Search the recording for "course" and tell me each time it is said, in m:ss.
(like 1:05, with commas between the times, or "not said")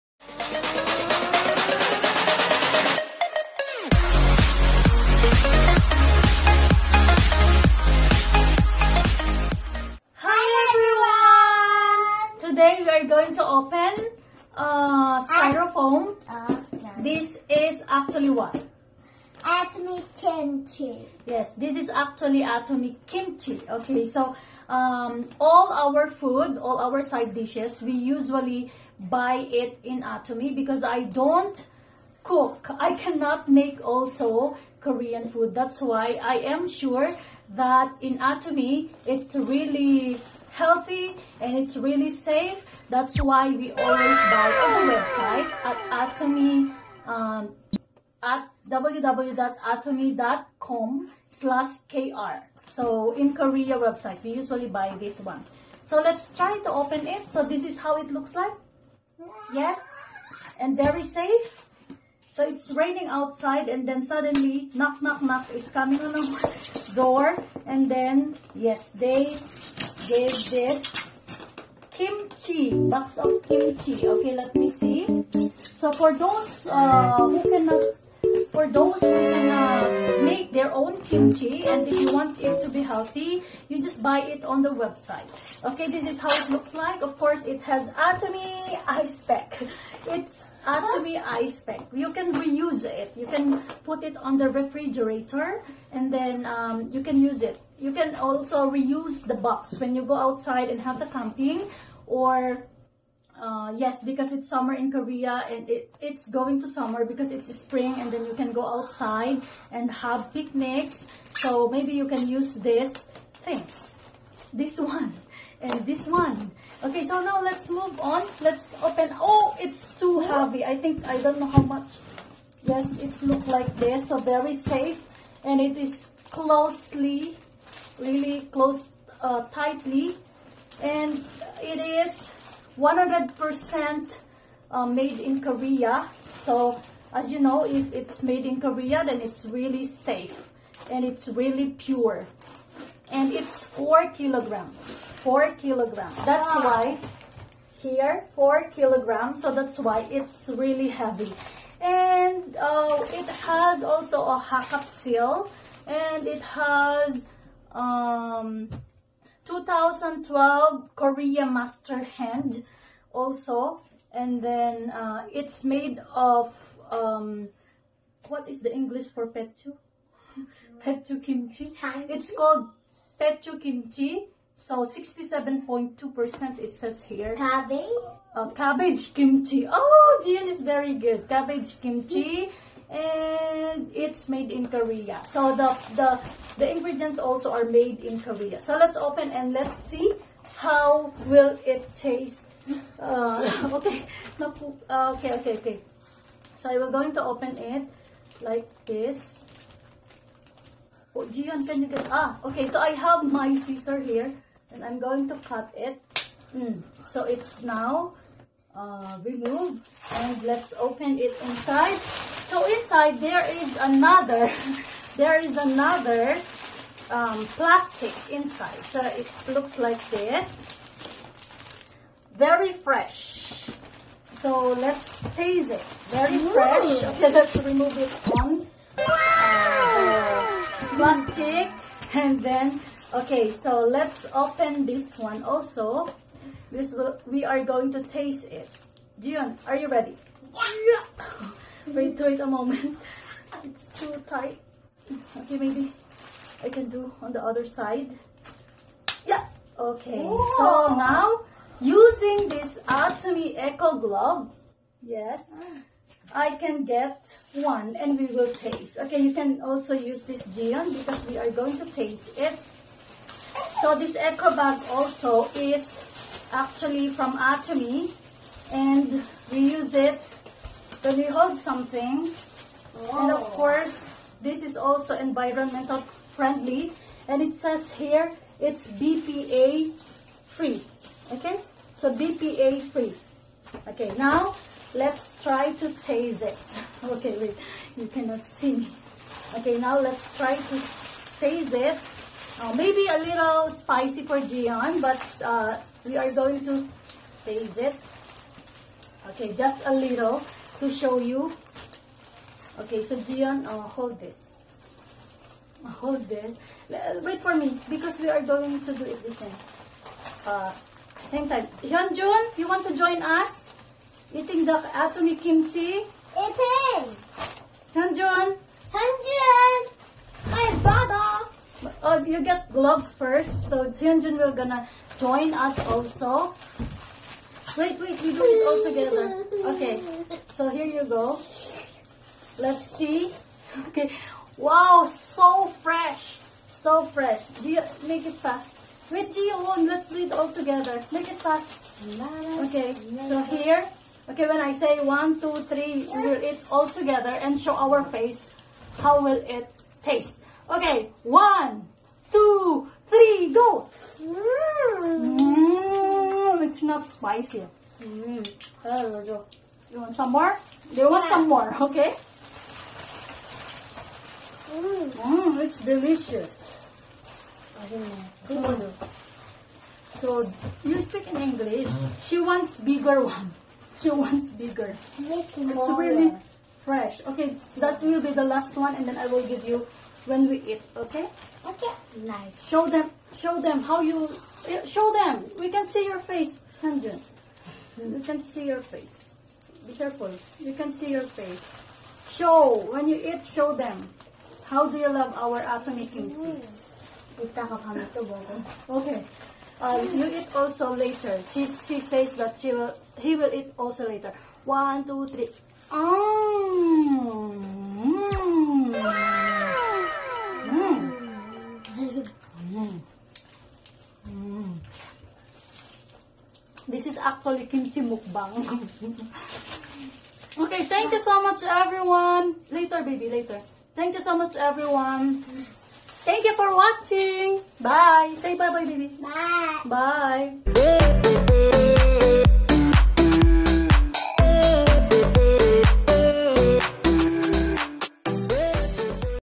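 1:27, 4:33.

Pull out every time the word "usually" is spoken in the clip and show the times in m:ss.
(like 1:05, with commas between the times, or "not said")
0:27, 0:54.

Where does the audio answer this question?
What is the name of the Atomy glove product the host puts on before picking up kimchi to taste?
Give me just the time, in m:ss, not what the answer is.
4:12.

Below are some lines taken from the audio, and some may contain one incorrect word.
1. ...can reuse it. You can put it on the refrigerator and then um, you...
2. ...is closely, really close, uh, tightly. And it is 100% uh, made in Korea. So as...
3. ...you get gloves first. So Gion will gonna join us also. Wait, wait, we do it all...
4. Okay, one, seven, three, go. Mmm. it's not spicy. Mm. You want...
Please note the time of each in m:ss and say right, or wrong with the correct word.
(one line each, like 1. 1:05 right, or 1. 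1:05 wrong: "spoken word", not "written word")
1. 1:32 right
2. 2:05 right
3. 5:22 wrong: "Hyunjun", not "Gion"
4. 5:50 wrong: "two", not "seven".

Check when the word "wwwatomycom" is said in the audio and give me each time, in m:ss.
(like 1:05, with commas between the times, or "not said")
0:48.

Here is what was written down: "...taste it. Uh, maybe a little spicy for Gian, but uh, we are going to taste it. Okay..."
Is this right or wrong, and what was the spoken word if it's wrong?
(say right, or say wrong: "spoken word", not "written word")
right.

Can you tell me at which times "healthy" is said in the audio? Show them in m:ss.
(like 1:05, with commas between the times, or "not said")
0:40, 1:22.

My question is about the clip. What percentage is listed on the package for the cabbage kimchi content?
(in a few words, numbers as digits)
67.2%.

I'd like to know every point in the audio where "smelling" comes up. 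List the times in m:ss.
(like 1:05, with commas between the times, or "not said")
not said.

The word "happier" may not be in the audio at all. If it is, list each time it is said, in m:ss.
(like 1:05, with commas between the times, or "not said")
not said.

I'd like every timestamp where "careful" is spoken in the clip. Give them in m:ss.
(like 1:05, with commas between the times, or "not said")
6:29.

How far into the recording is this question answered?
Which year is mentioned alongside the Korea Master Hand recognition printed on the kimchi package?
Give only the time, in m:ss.
2:39.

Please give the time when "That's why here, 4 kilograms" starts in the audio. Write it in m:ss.
2:26.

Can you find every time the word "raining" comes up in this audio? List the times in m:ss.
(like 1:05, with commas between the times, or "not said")
1:02.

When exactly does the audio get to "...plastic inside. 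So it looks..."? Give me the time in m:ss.
3:37.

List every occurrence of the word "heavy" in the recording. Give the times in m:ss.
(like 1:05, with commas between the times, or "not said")
2:00, 2:30.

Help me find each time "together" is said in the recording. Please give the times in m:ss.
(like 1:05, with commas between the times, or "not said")
5:28, 5:40, 5:46.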